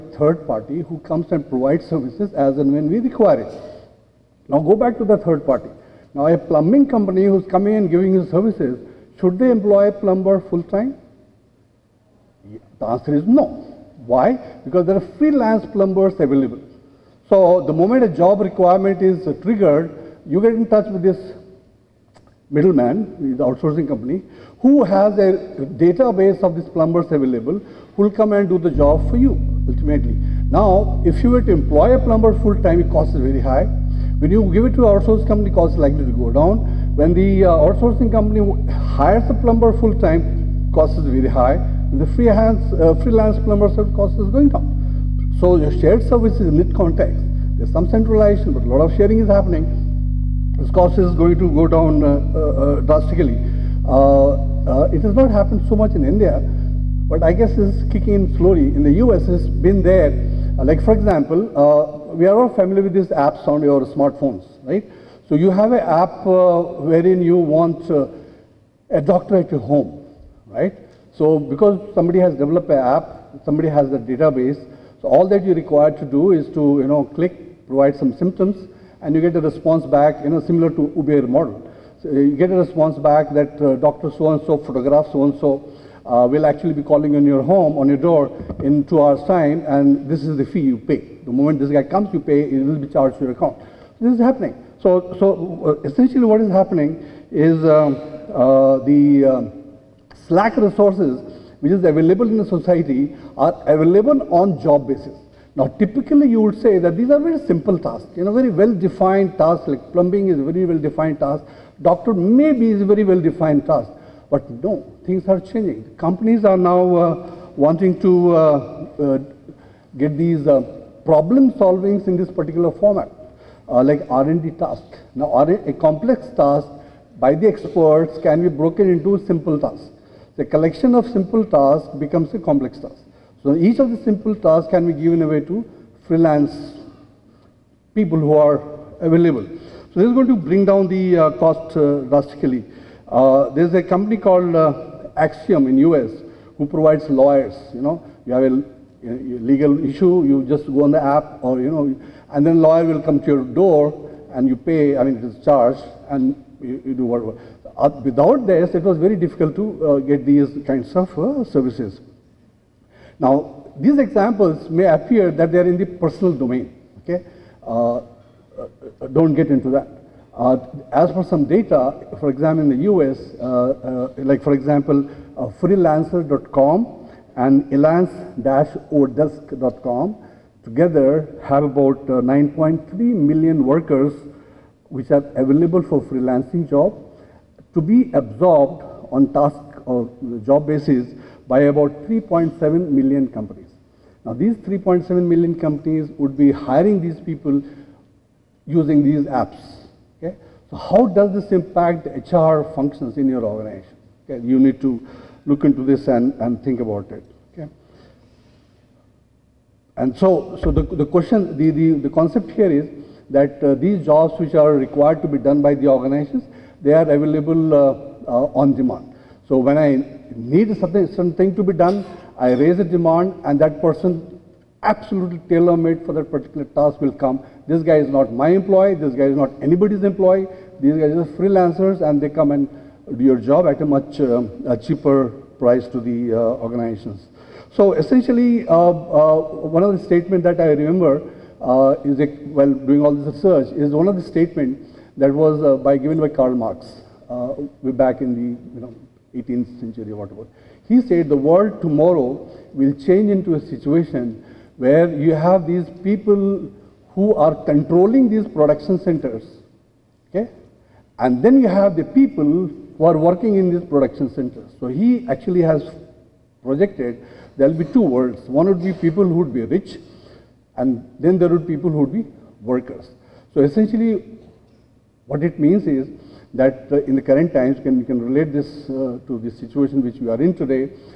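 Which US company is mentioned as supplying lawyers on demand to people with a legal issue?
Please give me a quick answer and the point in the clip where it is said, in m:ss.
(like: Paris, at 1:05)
Axiom, at 2:25.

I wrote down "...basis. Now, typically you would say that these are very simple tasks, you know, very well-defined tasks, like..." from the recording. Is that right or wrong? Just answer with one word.
right.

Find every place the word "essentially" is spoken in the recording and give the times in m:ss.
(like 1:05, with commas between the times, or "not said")
1:35, 3:57, 4:33.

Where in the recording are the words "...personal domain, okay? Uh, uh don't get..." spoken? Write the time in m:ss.
2:45.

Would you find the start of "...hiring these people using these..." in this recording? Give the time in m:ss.
3:16.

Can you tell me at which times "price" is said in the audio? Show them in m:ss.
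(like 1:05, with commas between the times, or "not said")
3:55.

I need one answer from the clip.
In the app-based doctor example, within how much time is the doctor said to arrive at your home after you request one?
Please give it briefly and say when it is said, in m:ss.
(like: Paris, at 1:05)
2 hours, at 1:28.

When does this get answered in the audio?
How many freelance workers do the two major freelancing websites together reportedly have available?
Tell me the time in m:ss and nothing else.
3:02.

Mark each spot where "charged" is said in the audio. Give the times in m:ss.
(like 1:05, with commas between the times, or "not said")
1:32, 2:35.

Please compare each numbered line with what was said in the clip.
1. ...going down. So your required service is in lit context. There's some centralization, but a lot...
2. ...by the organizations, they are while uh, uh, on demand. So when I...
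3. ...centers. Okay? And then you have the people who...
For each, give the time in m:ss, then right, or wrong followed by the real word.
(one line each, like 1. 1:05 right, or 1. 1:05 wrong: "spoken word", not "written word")
1. 0:44 wrong: "shared", not "required"
2. 3:35 wrong: "available", not "while"
3. 4:18 right.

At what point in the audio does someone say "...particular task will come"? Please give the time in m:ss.
3:46.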